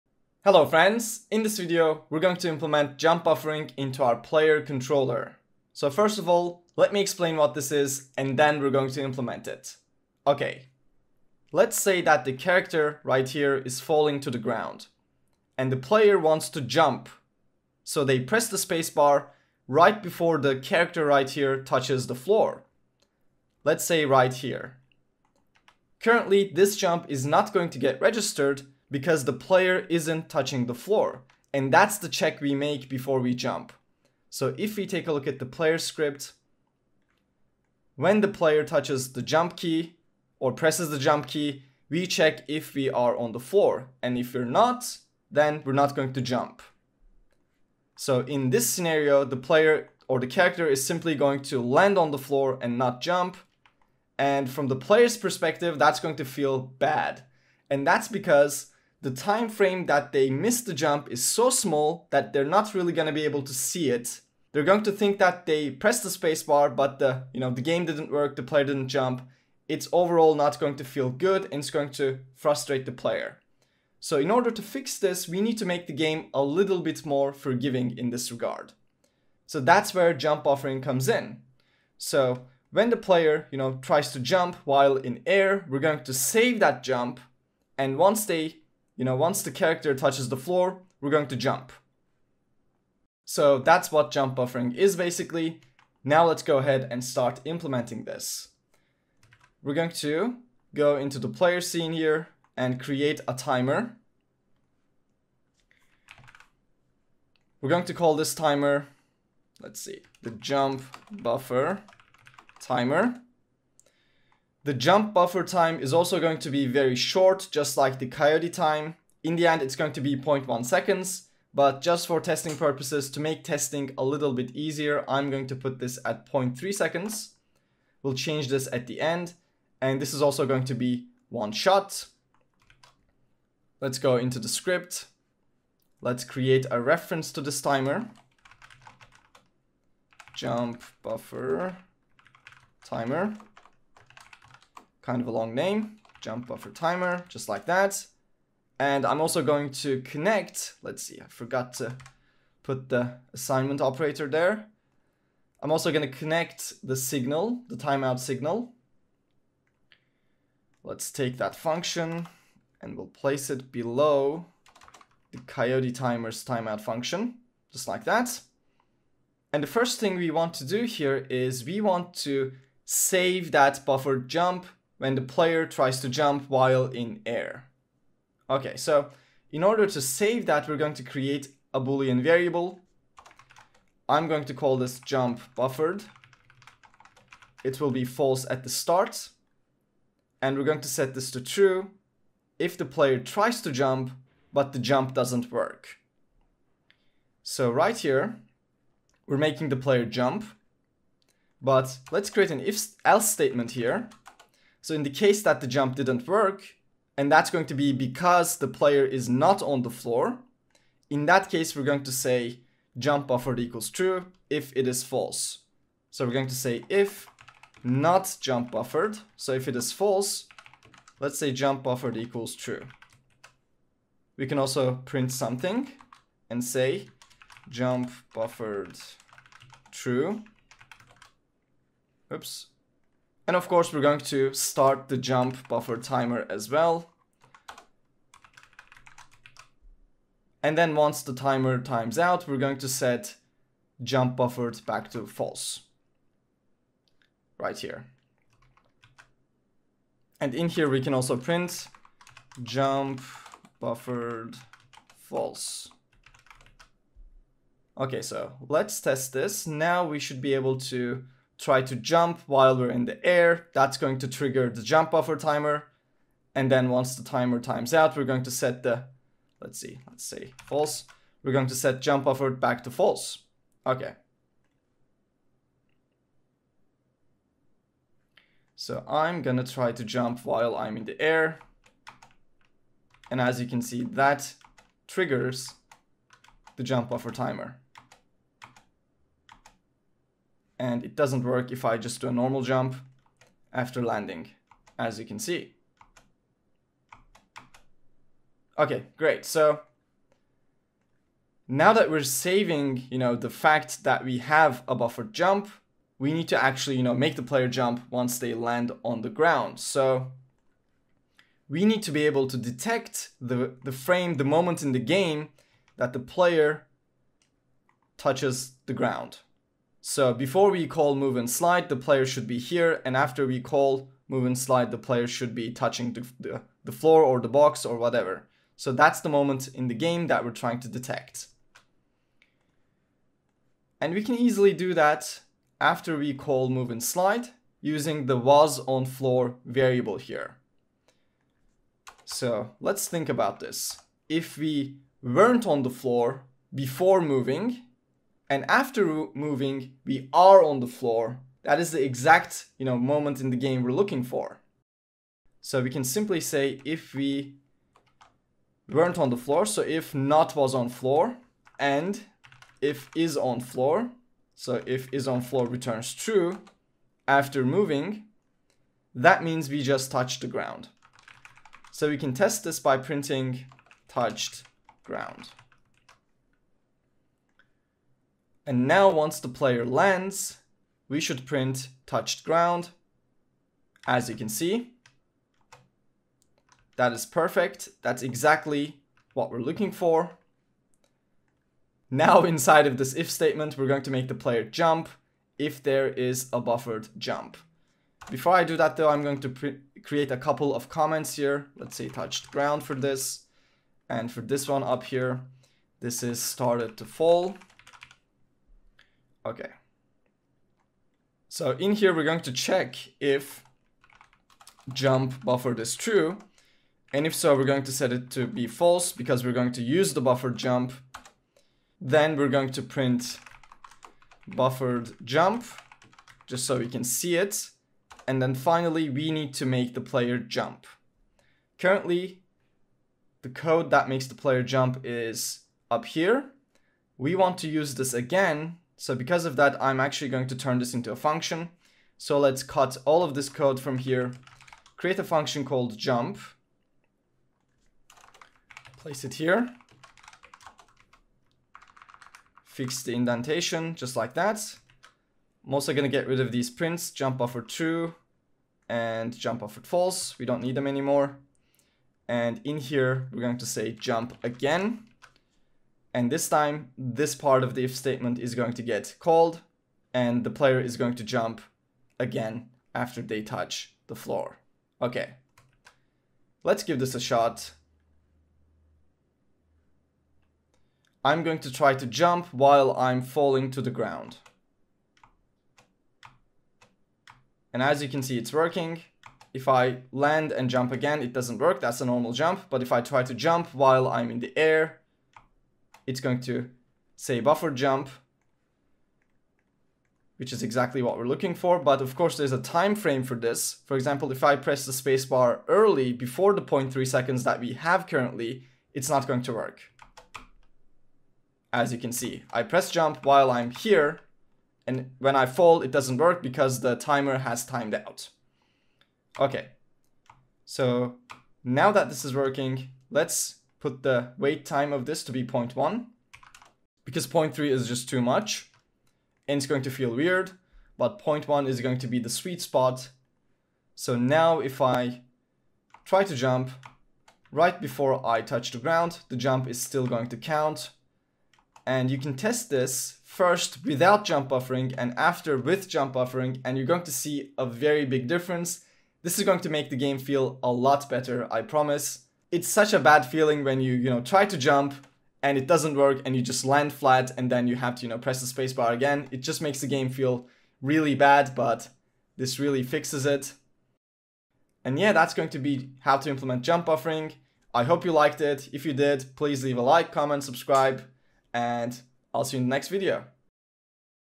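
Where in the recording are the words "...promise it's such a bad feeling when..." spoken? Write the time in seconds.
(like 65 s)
551 s.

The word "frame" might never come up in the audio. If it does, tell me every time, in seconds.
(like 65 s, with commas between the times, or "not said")
59 s, 313 s, 502 s.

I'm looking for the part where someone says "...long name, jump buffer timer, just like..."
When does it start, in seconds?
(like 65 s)
145 s.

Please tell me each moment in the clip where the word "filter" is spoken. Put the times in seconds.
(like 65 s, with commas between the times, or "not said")
not said.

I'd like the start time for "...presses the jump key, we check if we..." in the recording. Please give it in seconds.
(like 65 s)
40 s.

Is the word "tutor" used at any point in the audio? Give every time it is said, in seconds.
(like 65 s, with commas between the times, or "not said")
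not said.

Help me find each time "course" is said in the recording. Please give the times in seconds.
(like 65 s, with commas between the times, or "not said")
233 s, 502 s.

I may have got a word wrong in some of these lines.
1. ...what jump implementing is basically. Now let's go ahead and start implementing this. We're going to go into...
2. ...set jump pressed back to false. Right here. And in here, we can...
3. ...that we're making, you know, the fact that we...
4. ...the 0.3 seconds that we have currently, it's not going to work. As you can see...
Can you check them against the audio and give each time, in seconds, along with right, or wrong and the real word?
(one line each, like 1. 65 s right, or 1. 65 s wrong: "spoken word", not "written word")
1. 93 s wrong: "buffering", not "implementing"
2. 242 s wrong: "buffered", not "pressed"
3. 301 s wrong: "saving", not "making"
4. 506 s right.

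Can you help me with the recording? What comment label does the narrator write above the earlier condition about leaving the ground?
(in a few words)
started to fall.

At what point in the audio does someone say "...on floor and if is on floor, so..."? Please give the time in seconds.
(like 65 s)
360 s.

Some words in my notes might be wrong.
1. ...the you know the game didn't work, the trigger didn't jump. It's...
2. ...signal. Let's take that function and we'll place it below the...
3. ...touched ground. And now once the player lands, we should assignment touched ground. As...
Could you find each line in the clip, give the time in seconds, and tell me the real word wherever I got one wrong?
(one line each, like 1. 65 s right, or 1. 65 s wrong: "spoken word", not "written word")
1. 66 s wrong: "player", not "trigger"
2. 158 s right
3. 374 s wrong: "print", not "assignment".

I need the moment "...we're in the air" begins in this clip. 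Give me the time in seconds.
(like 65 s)
262 s.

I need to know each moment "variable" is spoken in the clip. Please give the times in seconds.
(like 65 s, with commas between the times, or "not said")
182 s, 339 s.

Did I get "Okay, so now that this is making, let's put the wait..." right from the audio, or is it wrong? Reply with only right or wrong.
wrong.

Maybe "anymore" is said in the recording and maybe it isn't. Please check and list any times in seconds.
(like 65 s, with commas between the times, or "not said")
460 s.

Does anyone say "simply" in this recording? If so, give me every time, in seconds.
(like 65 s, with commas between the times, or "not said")
50 s, 356 s.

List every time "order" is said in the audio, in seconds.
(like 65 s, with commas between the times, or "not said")
74 s, 179 s.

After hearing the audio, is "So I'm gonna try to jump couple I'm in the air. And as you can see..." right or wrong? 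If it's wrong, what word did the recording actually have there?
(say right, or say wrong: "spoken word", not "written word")
wrong: "while", not "couple".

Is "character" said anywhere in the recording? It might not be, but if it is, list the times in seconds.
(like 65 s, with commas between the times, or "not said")
12 s, 20 s, 50 s, 89 s.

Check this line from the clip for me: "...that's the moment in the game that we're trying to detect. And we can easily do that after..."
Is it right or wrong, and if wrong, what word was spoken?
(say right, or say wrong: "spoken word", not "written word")
right.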